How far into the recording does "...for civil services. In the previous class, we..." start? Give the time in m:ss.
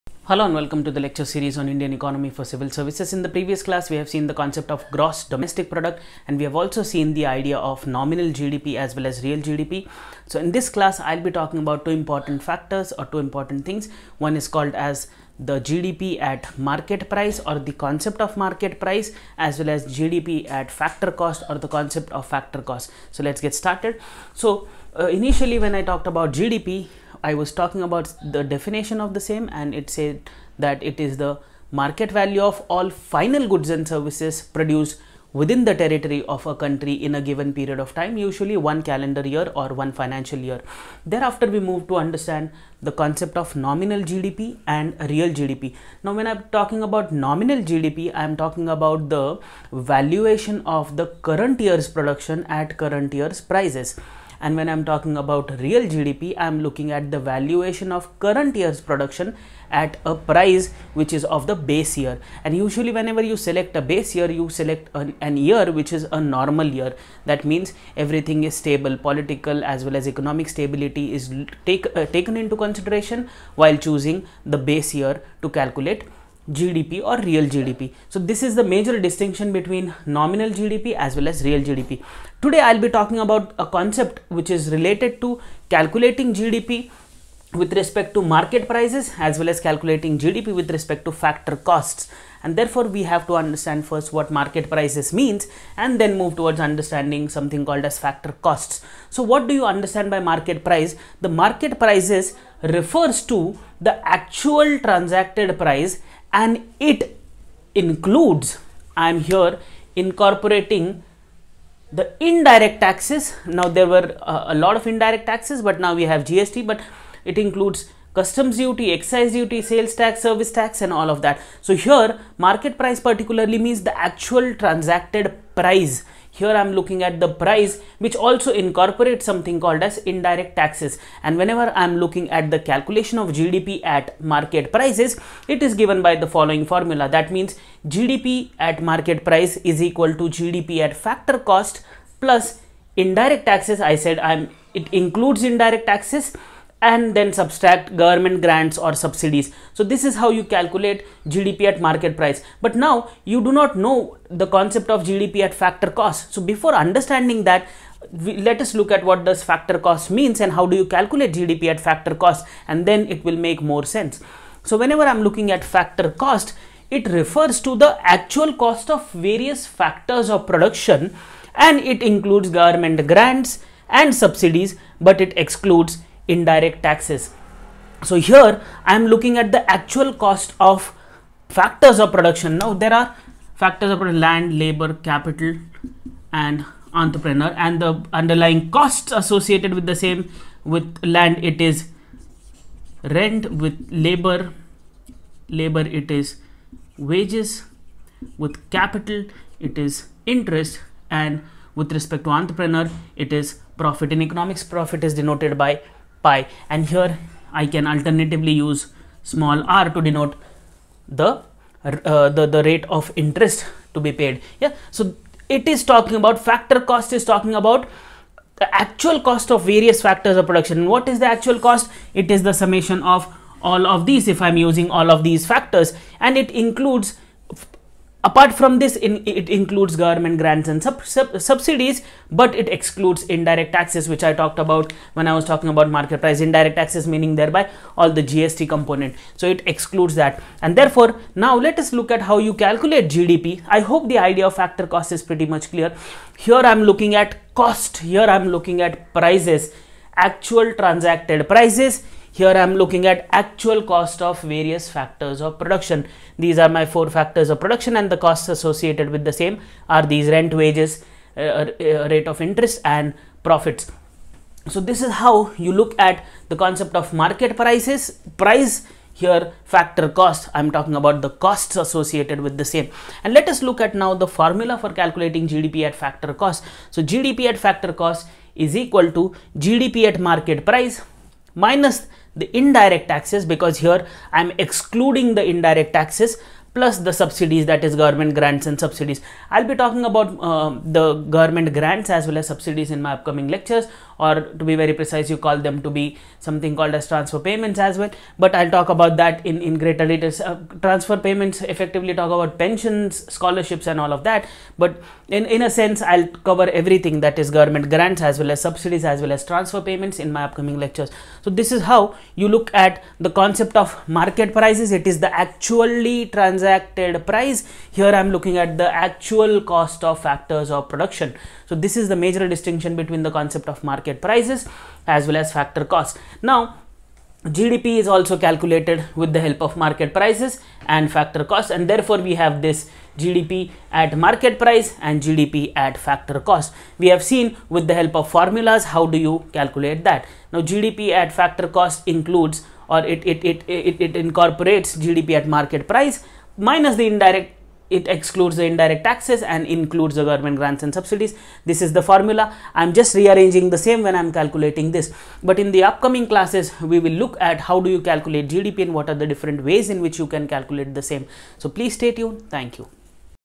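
0:02.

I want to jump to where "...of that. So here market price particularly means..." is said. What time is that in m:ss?
2:01.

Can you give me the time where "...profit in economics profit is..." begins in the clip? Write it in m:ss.
3:23.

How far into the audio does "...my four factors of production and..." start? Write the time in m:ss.
4:16.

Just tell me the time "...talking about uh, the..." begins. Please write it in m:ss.
4:49.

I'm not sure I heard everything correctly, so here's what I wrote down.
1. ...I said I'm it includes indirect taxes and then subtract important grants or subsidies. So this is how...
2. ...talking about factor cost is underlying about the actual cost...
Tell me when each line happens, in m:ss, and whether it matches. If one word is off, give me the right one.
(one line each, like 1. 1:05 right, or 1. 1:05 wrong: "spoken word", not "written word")
1. 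2:23 wrong: "government", not "important"
2. 3:35 wrong: "talking", not "underlying".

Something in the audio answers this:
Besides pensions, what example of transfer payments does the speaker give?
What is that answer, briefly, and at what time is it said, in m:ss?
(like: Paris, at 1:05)
Scholarships, at 5:03.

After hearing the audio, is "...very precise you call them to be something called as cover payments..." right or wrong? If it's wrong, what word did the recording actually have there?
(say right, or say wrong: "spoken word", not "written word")
wrong: "transfer", not "cover".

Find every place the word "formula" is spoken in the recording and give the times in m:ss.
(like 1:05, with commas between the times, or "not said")
2:16, 4:34, 5:38, 5:52.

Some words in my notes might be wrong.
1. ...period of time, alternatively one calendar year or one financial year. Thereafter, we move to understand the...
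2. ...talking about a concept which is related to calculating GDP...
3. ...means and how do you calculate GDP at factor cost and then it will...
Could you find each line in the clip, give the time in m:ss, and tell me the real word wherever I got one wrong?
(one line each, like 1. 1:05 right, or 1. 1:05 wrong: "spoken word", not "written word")
1. 0:37 wrong: "usually", not "alternatively"
2. 1:22 right
3. 2:40 right.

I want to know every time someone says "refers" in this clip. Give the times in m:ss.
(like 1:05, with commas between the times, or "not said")
1:42, 2:47.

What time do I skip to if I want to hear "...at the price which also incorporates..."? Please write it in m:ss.
2:07.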